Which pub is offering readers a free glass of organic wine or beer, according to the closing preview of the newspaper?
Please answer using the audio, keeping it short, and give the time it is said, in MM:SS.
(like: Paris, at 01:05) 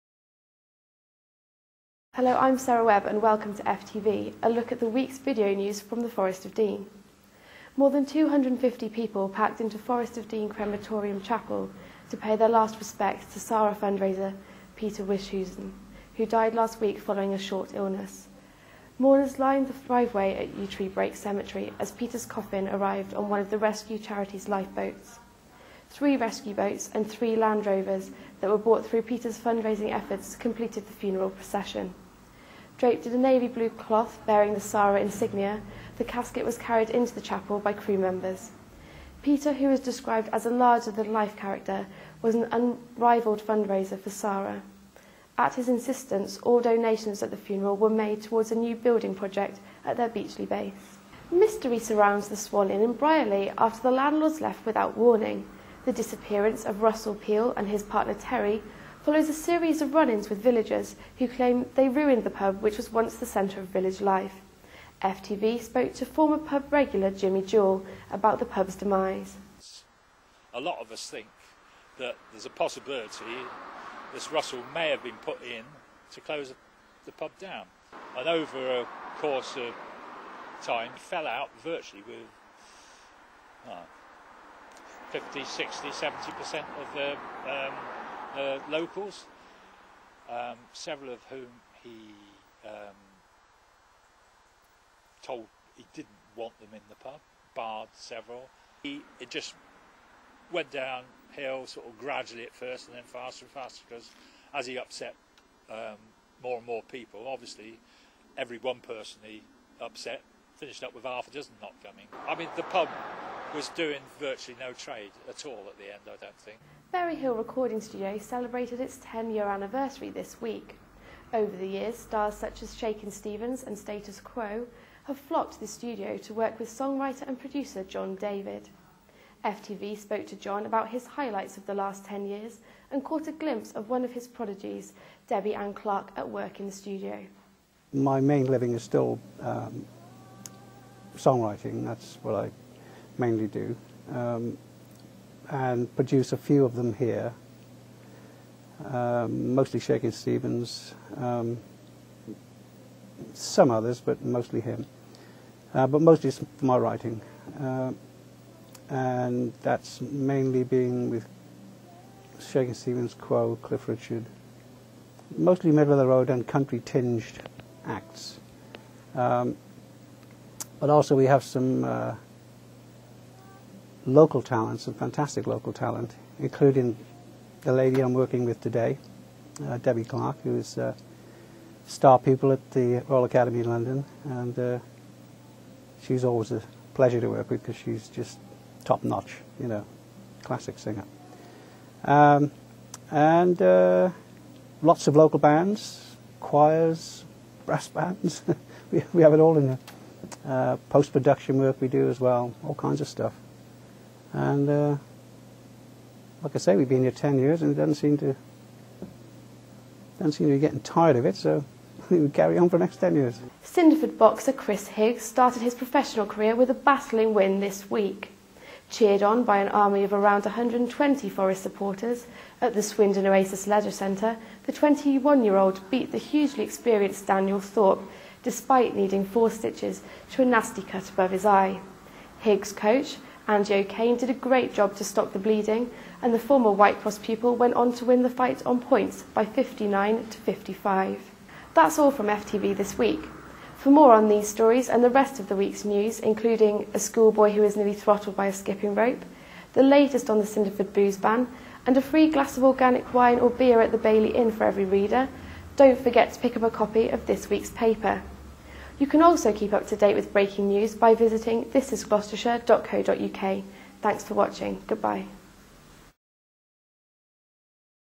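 Bailey Inn, at 04:13.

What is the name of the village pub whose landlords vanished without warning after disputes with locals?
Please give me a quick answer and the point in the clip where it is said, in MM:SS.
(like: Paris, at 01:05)
Swan Inn, at 00:52.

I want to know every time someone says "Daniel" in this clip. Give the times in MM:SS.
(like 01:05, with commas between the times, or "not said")
03:47.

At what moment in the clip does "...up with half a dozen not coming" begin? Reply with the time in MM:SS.
01:50.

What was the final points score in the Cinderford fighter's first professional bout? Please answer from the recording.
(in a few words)
59 to 55.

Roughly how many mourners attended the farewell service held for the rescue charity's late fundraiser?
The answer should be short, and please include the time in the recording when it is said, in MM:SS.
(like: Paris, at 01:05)
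More than 250, at 00:07.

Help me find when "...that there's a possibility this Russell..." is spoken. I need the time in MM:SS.
01:11.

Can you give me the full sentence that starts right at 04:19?
You can also keep up to date with breaking news by visiting thisisgloucestershire.co.uk.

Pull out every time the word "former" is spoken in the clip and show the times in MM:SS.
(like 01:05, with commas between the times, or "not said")
01:06, 03:56.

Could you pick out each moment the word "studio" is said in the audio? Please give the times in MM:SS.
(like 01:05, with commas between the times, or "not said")
01:57, 02:05, 02:16.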